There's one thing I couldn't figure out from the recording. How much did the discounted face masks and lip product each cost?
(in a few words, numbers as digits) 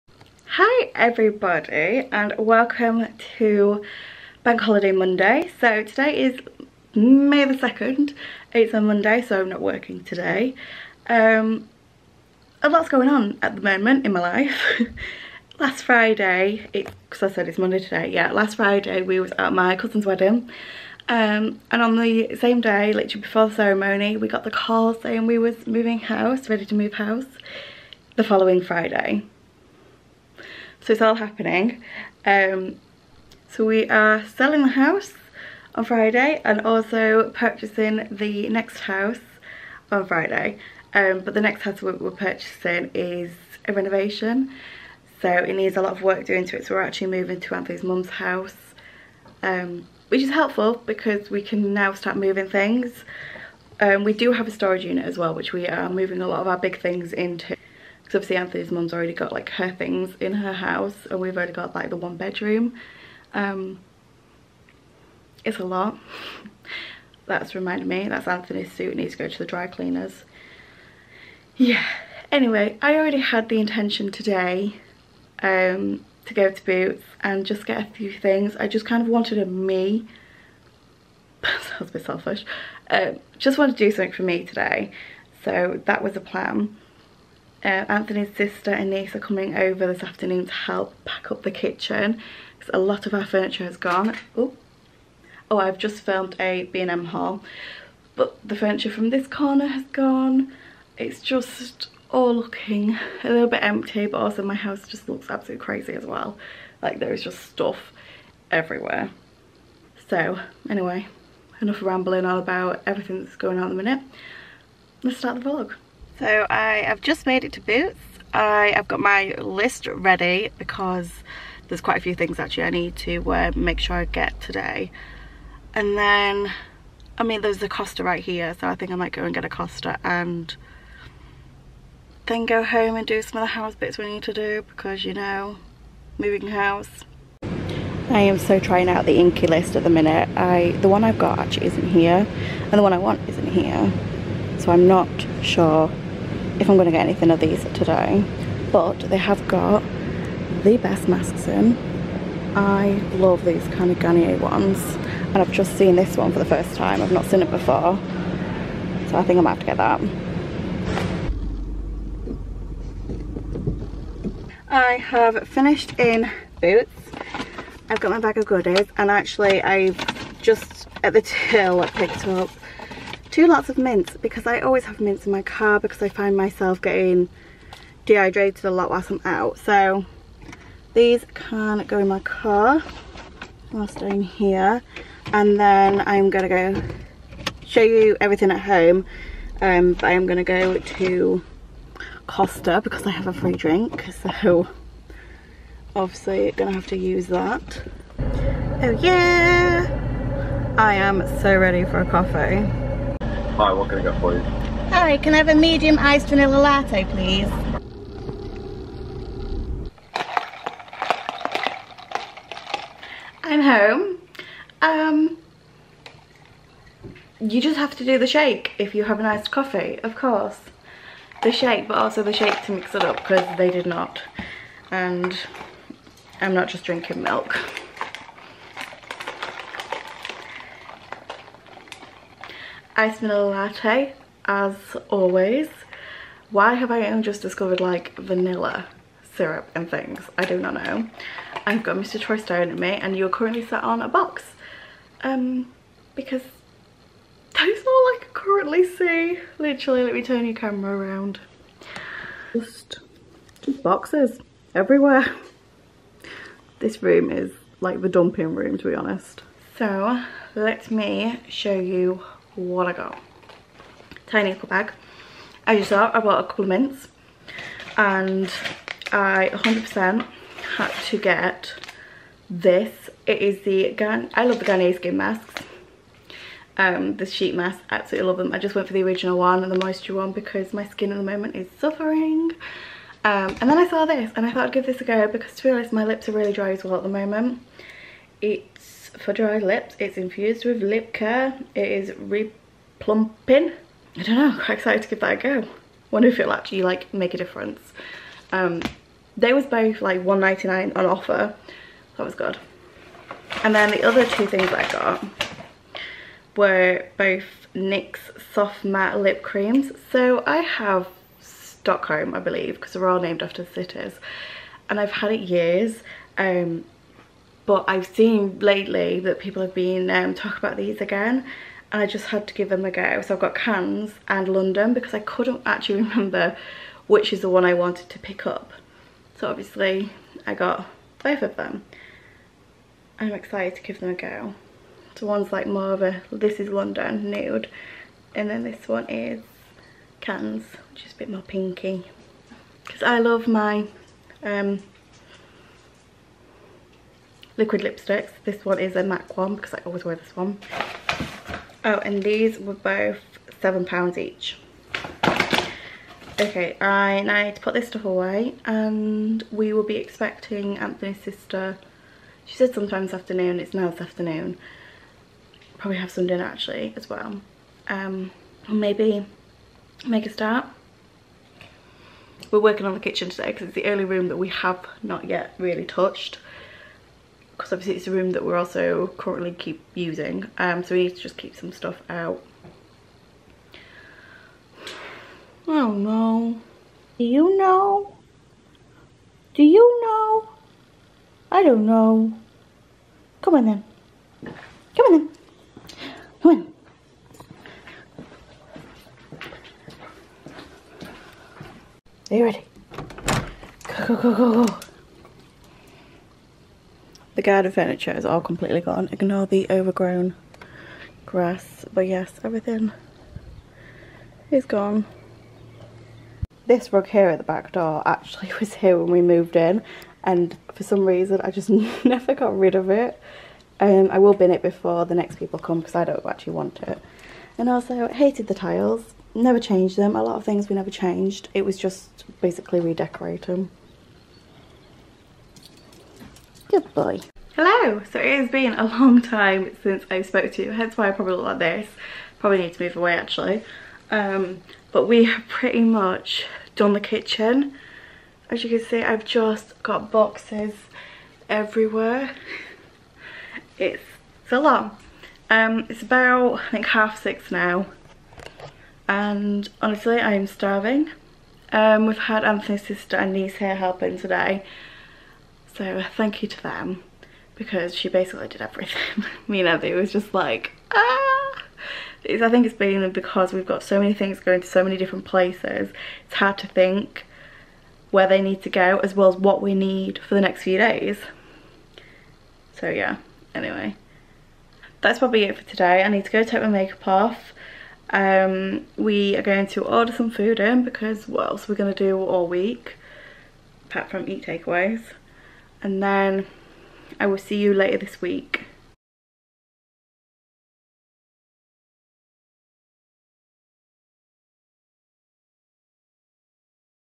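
1.99.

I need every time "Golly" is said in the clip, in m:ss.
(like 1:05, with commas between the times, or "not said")
not said.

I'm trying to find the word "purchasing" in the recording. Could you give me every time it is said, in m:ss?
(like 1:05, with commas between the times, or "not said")
0:37, 0:42.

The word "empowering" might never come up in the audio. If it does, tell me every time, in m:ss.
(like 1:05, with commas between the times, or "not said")
not said.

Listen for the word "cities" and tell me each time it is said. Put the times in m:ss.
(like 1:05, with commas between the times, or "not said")
5:13.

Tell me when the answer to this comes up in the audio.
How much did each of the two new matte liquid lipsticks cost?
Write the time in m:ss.
5:53.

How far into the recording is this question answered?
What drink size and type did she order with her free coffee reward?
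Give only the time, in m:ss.
3:25.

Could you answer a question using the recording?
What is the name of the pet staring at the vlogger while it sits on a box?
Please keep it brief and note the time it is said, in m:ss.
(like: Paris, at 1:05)
Mr. Troy, at 4:01.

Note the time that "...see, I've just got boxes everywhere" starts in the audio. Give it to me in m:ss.
7:28.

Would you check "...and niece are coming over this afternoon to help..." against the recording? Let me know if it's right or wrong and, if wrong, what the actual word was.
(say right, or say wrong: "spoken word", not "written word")
right.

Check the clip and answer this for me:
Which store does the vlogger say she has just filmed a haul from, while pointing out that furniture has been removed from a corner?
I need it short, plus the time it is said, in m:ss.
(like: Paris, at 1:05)
B&M, at 1:36.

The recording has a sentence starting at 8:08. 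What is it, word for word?
Um, we are going to order some food in because what else are we going to do all week?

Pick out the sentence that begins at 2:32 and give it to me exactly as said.
I love these kind of Garnier ones.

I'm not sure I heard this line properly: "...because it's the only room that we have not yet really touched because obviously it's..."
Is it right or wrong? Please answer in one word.
right.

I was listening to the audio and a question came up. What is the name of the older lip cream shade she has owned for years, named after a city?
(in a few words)
Stockholm.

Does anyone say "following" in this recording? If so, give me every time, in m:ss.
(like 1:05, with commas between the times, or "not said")
0:28.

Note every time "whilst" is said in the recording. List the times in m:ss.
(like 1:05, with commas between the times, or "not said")
2:58, 3:03.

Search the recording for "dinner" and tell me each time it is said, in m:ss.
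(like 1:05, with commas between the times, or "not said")
6:06.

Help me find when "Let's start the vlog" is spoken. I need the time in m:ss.
1:55.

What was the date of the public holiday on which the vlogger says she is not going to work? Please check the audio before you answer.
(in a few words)
May 2nd.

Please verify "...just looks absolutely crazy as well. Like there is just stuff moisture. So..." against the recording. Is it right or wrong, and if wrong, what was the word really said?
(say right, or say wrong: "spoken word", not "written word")
wrong: "everywhere", not "moisture".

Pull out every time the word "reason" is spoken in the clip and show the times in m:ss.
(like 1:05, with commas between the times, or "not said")
7:01.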